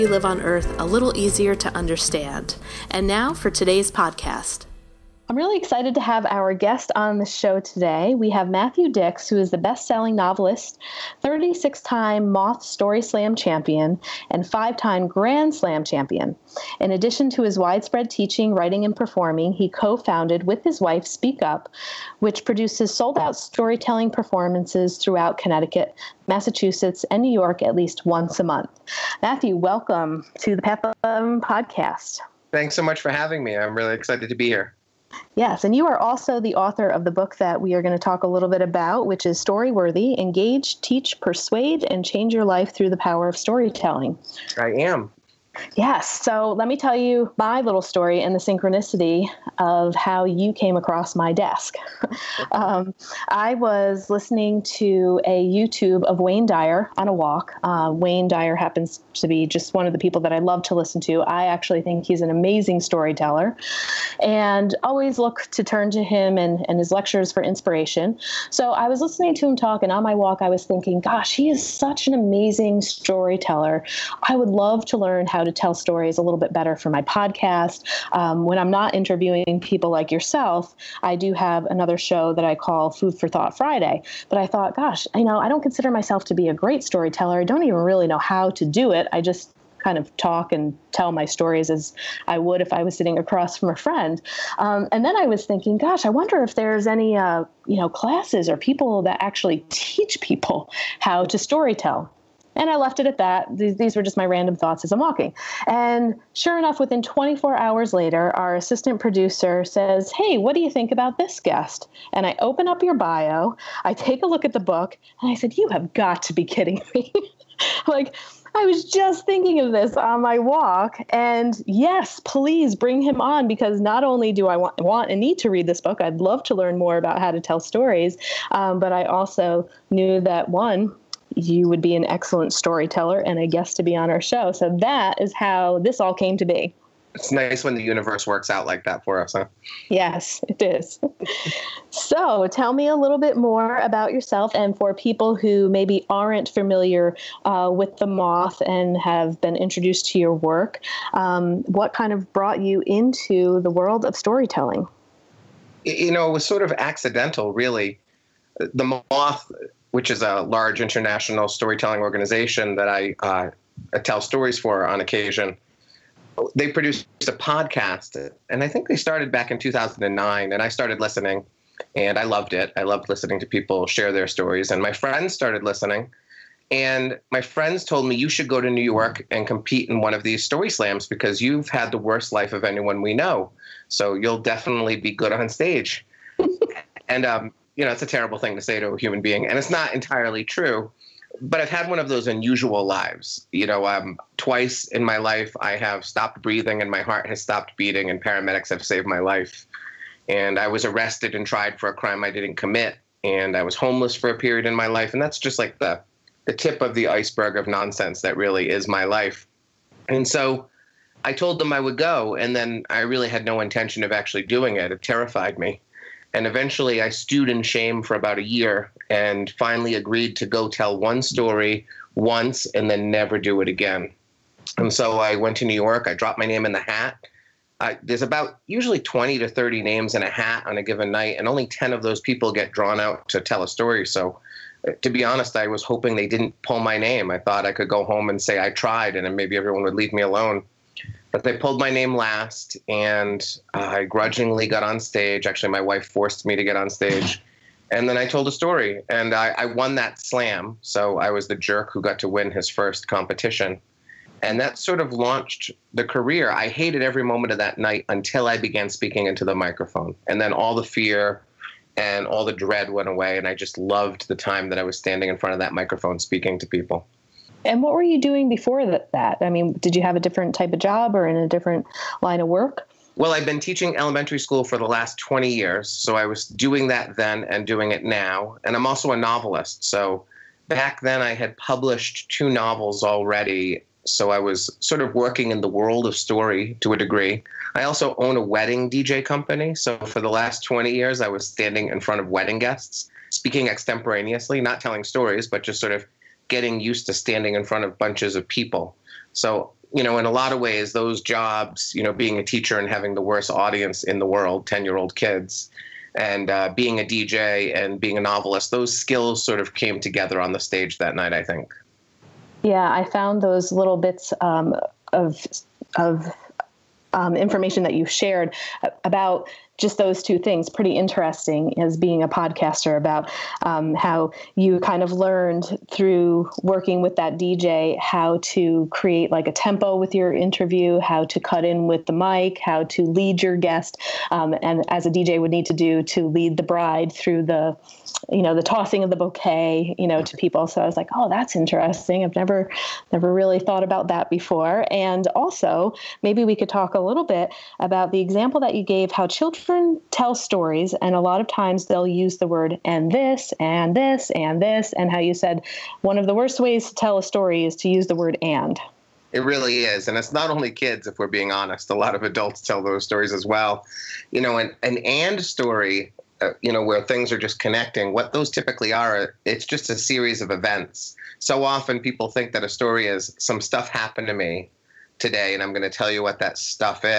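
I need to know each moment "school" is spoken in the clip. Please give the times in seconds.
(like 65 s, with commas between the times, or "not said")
274 s.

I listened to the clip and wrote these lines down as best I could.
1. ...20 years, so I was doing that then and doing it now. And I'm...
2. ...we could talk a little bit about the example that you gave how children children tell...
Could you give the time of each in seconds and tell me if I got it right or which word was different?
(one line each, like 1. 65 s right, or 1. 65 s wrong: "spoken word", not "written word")
1. 275 s right
2. 346 s right.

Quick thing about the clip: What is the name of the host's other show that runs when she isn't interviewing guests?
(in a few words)
Food for Thought Friday.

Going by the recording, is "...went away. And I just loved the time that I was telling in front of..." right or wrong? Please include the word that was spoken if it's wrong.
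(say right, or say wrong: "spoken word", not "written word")
wrong: "standing", not "telling".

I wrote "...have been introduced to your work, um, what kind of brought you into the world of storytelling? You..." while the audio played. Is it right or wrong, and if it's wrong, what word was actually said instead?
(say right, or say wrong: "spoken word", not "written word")
right.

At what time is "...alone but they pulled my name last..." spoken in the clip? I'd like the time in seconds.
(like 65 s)
240 s.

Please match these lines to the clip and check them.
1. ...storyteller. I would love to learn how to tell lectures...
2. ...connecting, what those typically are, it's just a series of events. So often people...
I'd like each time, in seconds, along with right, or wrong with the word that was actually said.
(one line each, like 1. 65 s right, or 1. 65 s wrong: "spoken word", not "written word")
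1. 72 s wrong: "stories", not "lectures"
2. 367 s right.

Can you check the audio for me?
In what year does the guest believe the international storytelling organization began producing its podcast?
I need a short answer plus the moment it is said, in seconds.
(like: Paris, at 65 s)
2009, at 169 s.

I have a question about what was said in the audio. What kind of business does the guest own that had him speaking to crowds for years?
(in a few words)
Wedding DJ company.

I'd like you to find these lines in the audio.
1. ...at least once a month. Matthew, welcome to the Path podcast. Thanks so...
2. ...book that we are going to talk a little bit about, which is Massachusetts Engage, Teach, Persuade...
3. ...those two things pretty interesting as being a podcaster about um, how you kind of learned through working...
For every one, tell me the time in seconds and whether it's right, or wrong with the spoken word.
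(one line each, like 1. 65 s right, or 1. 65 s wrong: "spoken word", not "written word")
1. 27 s right
2. 37 s wrong: "Storyworthy", not "Massachusetts"
3. 319 s right.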